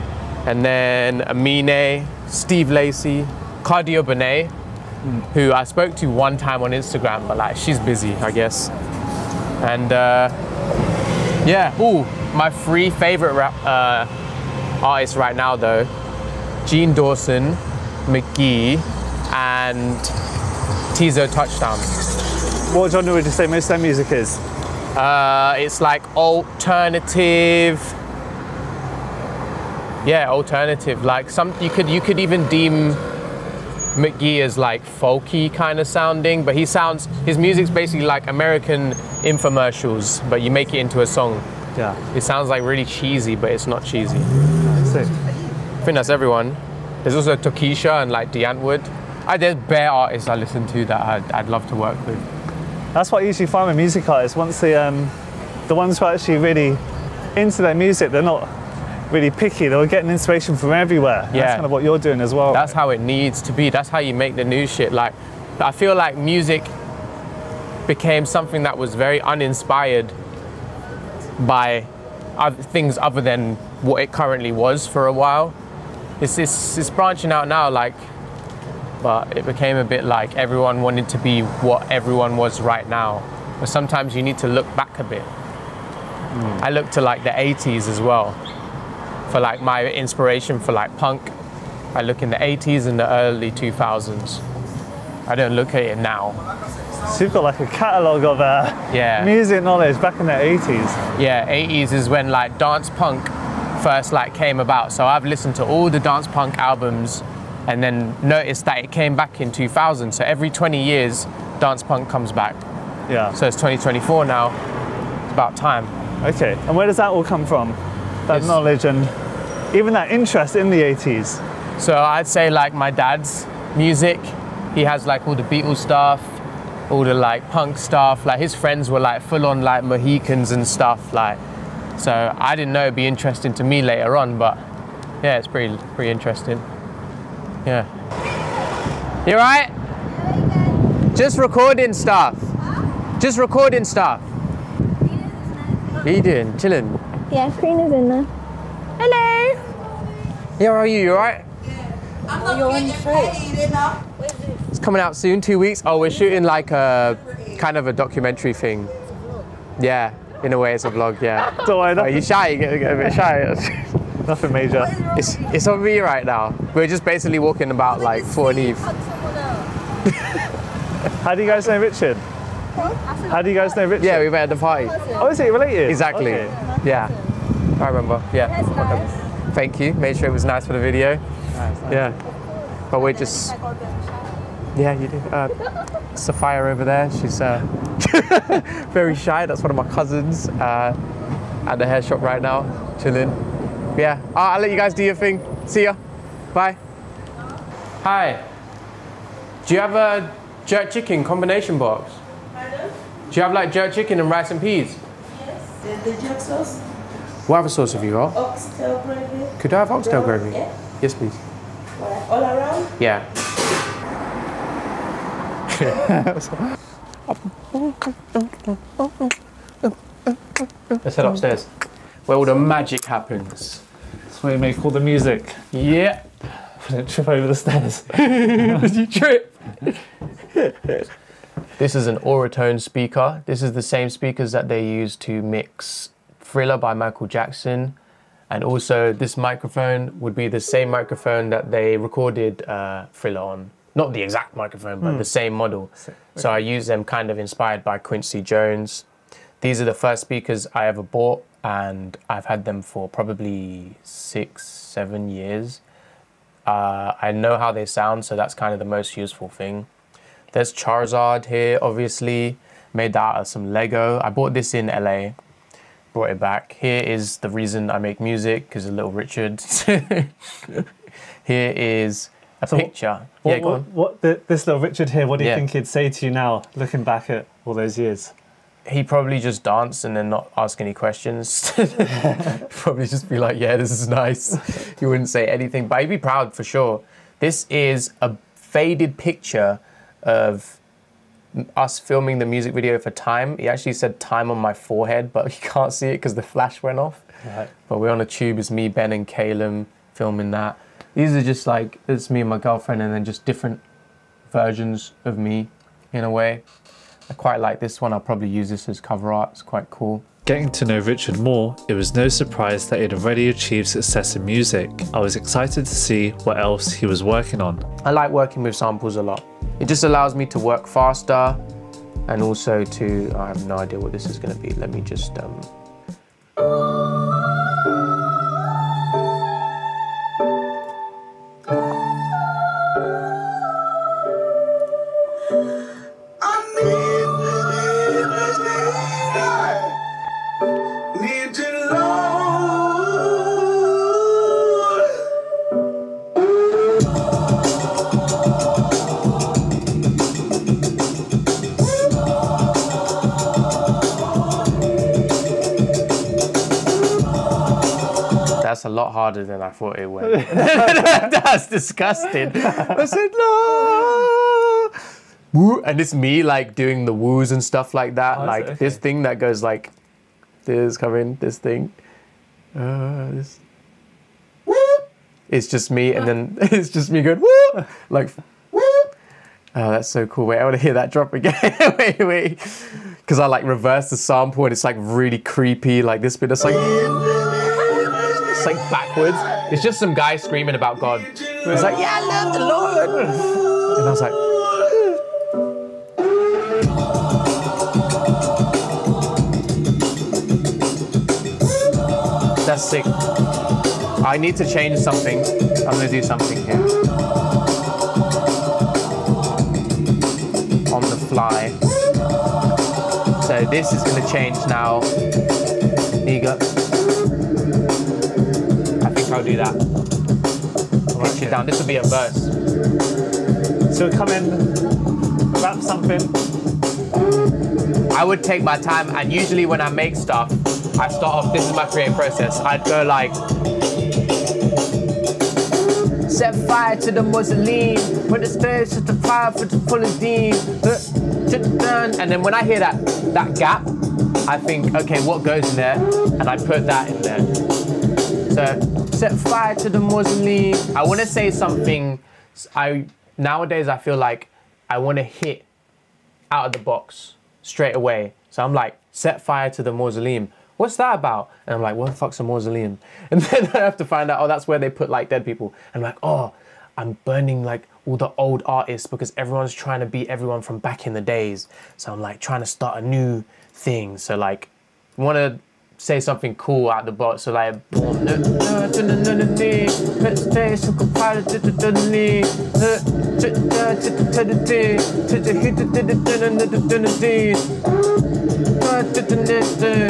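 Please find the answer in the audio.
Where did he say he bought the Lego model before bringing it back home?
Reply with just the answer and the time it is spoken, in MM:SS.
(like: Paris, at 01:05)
LA, at 04:24.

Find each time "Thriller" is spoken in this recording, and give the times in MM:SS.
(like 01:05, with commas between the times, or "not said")
03:56, 04:03.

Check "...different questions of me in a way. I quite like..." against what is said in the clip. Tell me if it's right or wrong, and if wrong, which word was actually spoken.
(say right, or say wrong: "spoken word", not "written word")
wrong: "versions", not "questions".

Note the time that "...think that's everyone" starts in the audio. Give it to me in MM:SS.
00:45.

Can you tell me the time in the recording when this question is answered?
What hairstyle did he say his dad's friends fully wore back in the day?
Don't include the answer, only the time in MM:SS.
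02:09.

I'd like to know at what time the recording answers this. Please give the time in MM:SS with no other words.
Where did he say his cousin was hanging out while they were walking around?
03:11.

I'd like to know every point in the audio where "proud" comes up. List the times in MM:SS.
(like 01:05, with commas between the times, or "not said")
04:46.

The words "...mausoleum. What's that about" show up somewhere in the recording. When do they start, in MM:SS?
07:39.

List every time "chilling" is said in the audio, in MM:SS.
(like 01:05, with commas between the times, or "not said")
02:26, 03:13.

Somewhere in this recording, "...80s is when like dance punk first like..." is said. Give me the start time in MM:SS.
01:41.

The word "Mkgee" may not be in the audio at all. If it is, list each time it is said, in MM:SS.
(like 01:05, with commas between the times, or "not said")
00:18, 00:33.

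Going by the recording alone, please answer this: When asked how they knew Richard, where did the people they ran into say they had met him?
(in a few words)
at the party.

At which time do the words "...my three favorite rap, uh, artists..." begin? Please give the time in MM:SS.
00:12.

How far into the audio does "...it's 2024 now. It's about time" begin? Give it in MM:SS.
01:53.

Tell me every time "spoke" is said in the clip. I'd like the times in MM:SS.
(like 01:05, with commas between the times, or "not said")
00:05.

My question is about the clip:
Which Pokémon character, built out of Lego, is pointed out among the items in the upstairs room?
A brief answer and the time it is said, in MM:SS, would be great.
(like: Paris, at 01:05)
Charizard, at 04:20.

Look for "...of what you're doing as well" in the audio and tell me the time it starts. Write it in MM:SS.
01:01.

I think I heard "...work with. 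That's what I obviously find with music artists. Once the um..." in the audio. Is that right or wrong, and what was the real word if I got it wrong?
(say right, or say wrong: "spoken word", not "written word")
wrong: "usually", not "obviously".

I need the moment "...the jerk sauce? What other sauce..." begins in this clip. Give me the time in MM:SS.
03:26.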